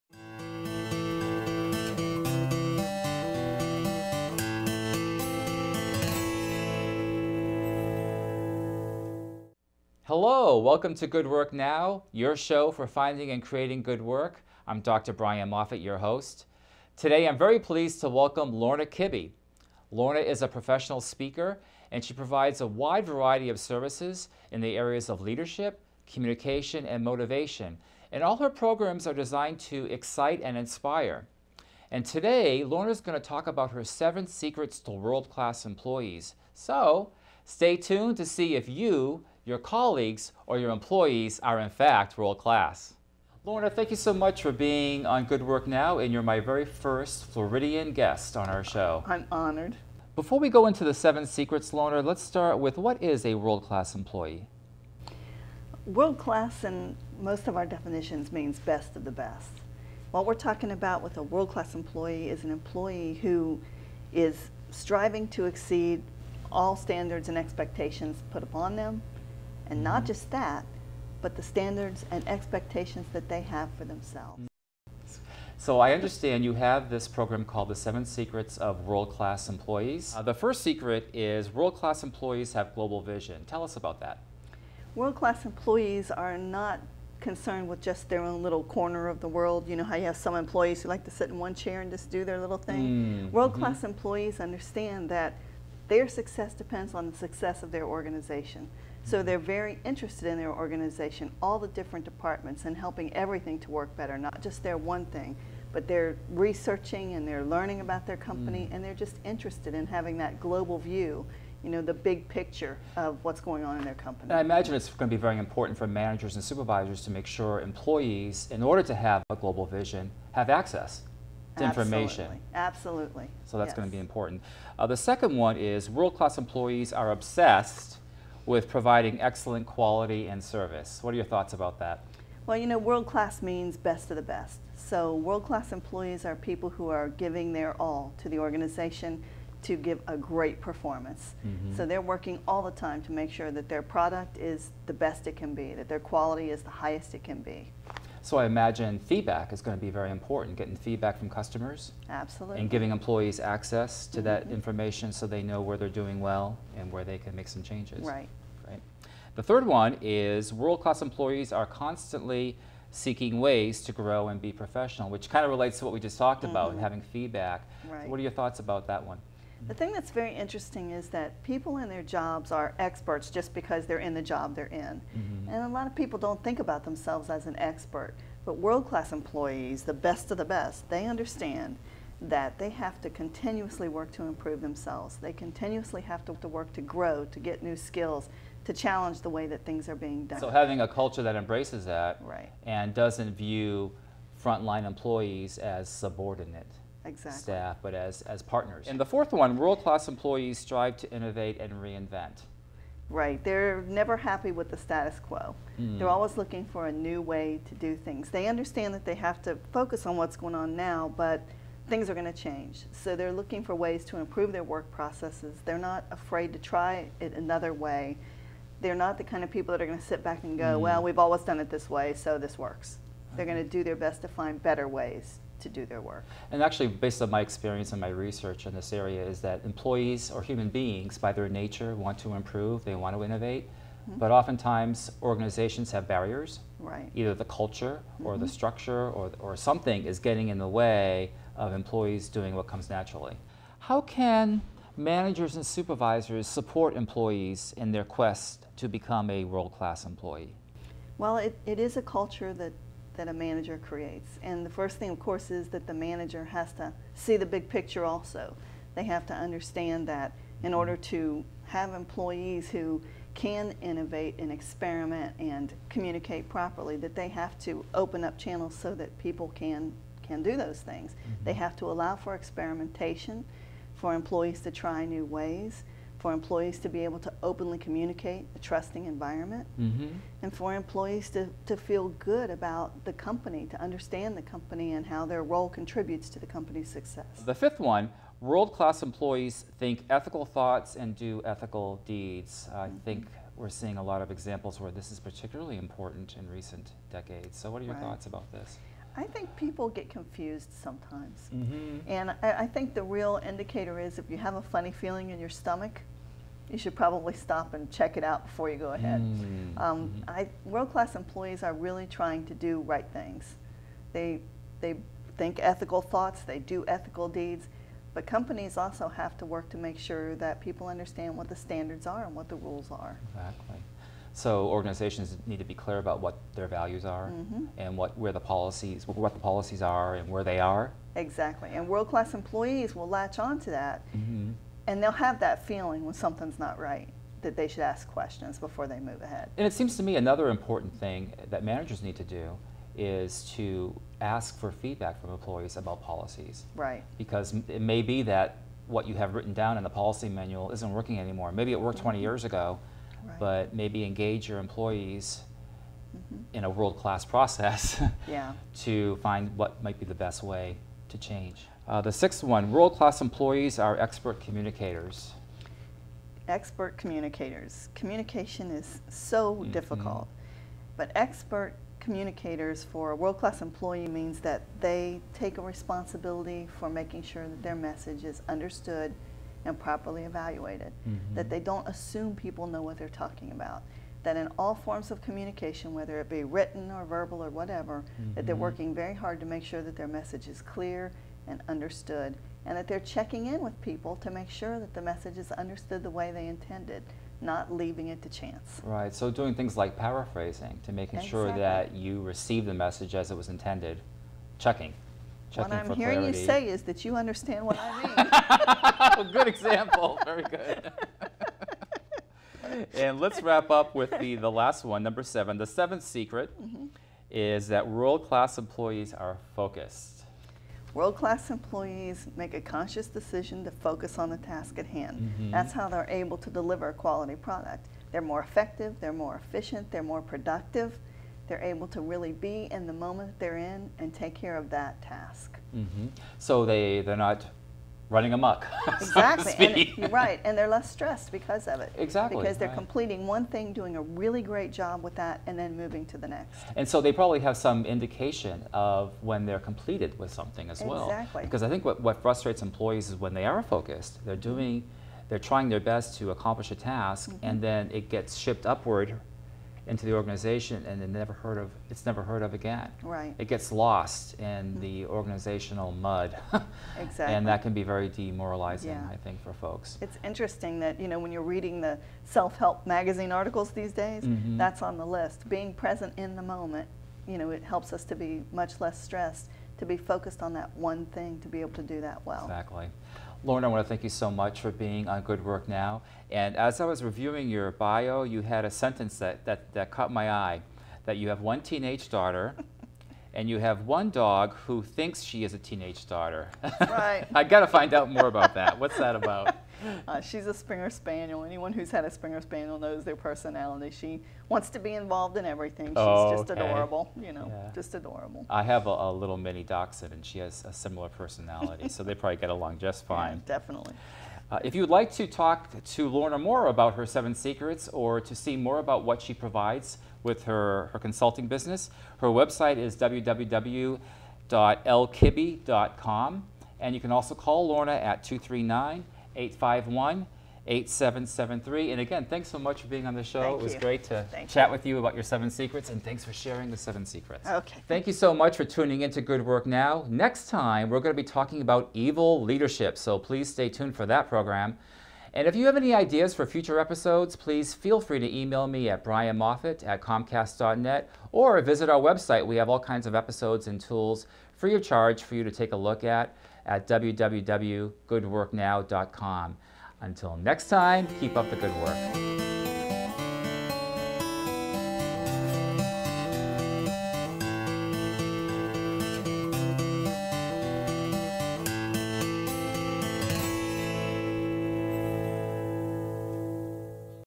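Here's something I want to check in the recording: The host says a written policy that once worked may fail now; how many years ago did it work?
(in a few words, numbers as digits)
20.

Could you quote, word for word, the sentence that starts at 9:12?
We have all kinds of episodes and tools free of charge for you to take a look at at www.goodworknow.com.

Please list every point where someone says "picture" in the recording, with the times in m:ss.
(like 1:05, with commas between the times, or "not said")
1:52, 4:17.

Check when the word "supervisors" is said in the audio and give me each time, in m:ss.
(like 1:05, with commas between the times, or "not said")
1:56, 4:05.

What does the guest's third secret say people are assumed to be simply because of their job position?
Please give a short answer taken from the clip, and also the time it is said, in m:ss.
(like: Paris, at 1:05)
Experts, at 2:52.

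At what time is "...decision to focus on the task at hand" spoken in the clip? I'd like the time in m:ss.
7:03.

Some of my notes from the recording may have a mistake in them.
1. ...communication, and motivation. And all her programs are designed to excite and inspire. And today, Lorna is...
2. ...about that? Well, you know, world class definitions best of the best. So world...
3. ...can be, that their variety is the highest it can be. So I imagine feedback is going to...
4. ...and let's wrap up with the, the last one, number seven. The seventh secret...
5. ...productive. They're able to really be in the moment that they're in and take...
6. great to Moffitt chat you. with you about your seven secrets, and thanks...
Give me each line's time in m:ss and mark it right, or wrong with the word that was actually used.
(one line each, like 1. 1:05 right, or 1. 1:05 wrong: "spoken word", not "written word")
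1. 0:26 right
2. 2:11 wrong: "means", not "definitions"
3. 2:25 wrong: "quality", not "variety"
4. 6:52 right
5. 7:10 right
6. 8:53 wrong: "Thank", not "Moffitt".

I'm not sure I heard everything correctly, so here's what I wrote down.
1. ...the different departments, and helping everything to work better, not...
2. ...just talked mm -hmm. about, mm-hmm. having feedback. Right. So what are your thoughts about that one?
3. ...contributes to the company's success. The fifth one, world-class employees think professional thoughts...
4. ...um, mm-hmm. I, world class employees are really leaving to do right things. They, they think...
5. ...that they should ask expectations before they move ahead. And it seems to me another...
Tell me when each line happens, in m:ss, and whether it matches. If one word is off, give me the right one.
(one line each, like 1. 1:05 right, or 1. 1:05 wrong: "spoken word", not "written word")
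1. 1:41 right
2. 2:46 right
3. 4:45 wrong: "ethical", not "professional"
4. 5:09 wrong: "trying", not "leaving"
5. 5:37 wrong: "questions", not "expectations".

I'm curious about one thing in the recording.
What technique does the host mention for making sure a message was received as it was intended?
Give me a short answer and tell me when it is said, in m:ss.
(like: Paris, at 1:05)
Paraphrasing, at 6:39.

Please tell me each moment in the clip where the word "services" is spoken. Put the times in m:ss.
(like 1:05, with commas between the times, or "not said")
0:23, 2:10.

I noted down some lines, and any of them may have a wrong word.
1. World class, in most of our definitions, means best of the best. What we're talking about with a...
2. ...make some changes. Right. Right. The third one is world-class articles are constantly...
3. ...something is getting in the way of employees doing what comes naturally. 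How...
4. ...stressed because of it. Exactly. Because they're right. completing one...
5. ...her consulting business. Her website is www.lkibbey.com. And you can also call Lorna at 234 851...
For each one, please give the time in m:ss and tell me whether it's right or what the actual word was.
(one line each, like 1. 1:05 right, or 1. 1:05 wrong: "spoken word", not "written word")
1. 0:55 right
2. 2:37 wrong: "employees", not "articles"
3. 3:59 right
4. 7:20 right
5. 8:40 wrong: "239", not "234".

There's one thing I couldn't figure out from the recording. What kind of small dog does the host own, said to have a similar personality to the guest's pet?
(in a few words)
Mini dachshund.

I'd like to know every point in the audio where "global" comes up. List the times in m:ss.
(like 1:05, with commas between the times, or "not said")
1:22, 1:50, 1:59.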